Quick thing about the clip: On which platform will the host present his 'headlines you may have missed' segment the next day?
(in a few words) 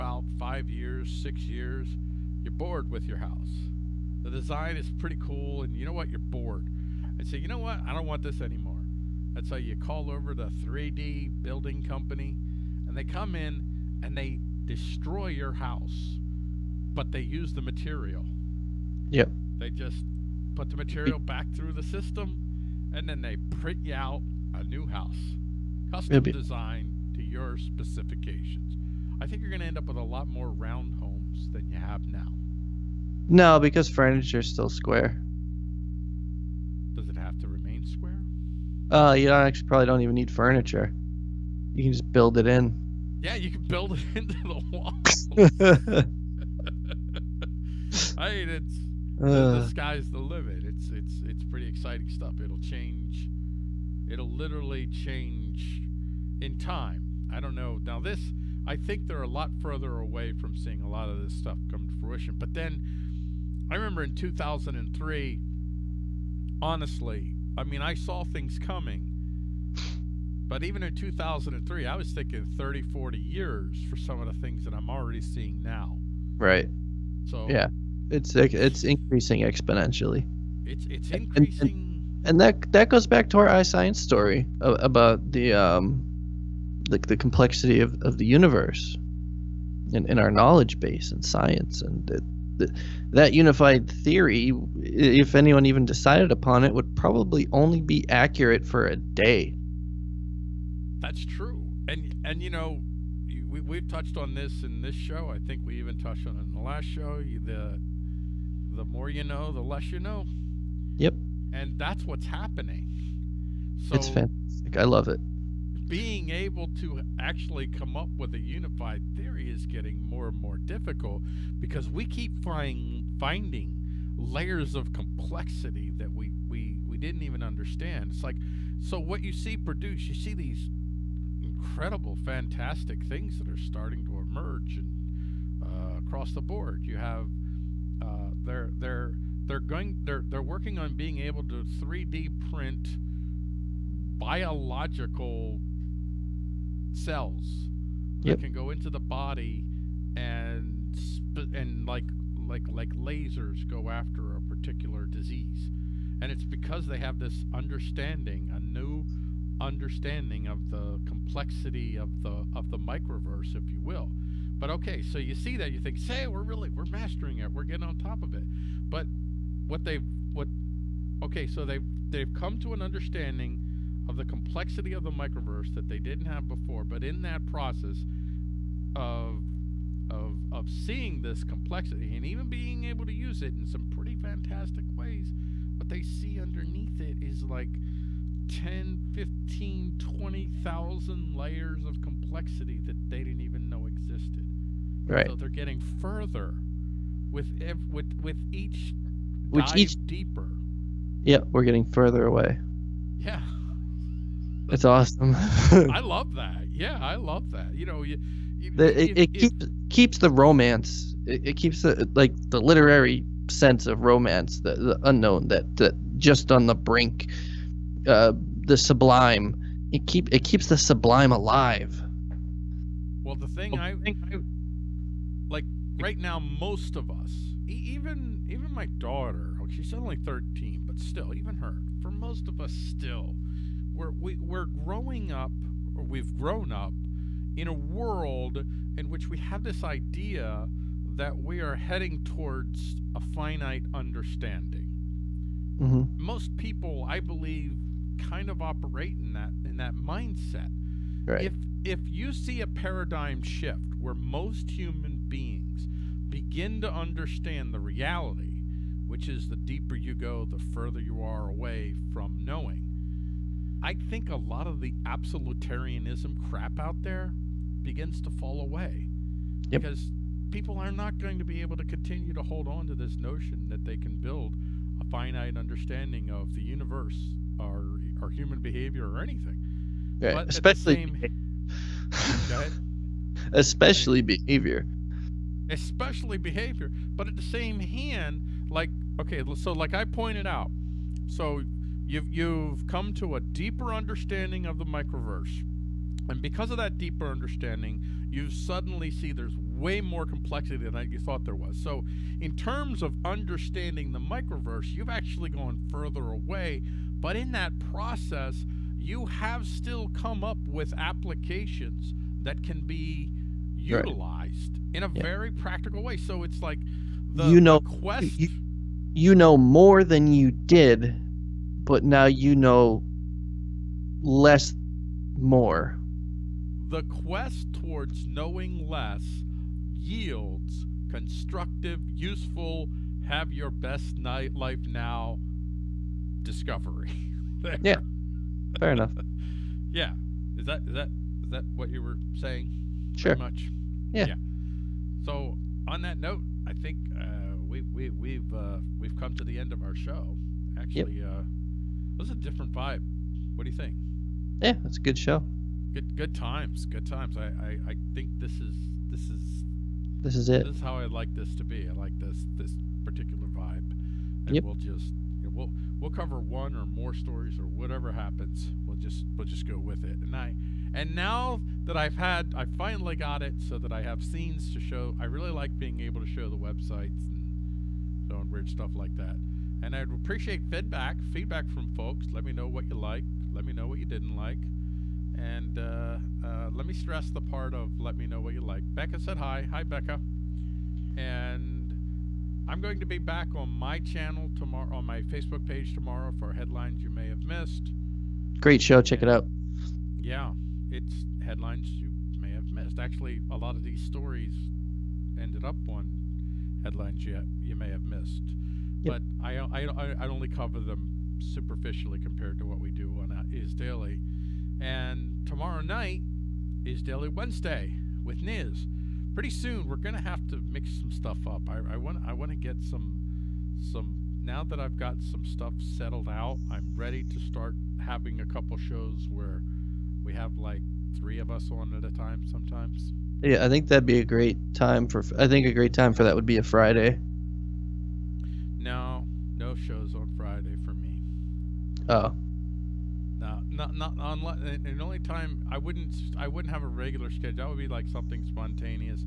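Facebook.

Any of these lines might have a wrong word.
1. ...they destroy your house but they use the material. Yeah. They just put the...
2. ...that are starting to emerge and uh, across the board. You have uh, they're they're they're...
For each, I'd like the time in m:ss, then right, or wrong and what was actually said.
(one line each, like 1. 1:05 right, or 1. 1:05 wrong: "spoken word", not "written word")
1. 0:14 right
2. 2:13 right.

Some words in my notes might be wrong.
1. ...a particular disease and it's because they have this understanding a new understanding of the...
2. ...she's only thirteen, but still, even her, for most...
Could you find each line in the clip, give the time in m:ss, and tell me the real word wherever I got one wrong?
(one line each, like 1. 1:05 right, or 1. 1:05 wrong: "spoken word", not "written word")
1. 2:34 right
2. 3:49 right.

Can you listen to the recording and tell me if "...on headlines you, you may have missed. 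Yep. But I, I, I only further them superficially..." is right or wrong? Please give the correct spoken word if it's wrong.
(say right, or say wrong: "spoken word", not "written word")
wrong: "cover", not "further".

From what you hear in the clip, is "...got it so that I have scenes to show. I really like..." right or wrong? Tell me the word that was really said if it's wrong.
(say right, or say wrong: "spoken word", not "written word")
right.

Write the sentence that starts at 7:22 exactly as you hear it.
Oh, no, not not unless and only time I wouldn't I wouldn't have a regular schedule.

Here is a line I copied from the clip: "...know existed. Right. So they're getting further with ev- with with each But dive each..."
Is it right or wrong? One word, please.
wrong.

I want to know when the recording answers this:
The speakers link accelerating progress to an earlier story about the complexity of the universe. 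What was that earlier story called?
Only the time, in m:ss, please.
1:23.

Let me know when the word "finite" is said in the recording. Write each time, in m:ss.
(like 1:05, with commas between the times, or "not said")
4:03, 4:35.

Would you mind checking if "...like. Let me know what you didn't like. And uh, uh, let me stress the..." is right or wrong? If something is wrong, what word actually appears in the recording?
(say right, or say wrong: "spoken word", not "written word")
right.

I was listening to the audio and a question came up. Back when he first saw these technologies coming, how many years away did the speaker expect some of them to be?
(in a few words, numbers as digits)
30 to 40 years.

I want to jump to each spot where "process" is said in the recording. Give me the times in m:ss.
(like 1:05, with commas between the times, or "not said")
2:57, 5:07.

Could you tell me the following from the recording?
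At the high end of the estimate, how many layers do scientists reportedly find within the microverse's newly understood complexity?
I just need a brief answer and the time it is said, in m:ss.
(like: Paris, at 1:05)
20,000, at 3:09.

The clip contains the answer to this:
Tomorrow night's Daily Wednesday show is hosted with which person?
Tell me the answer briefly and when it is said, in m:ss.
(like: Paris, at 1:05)
Niz, at 6:58.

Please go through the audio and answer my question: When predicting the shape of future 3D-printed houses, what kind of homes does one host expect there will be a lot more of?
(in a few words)
round homes.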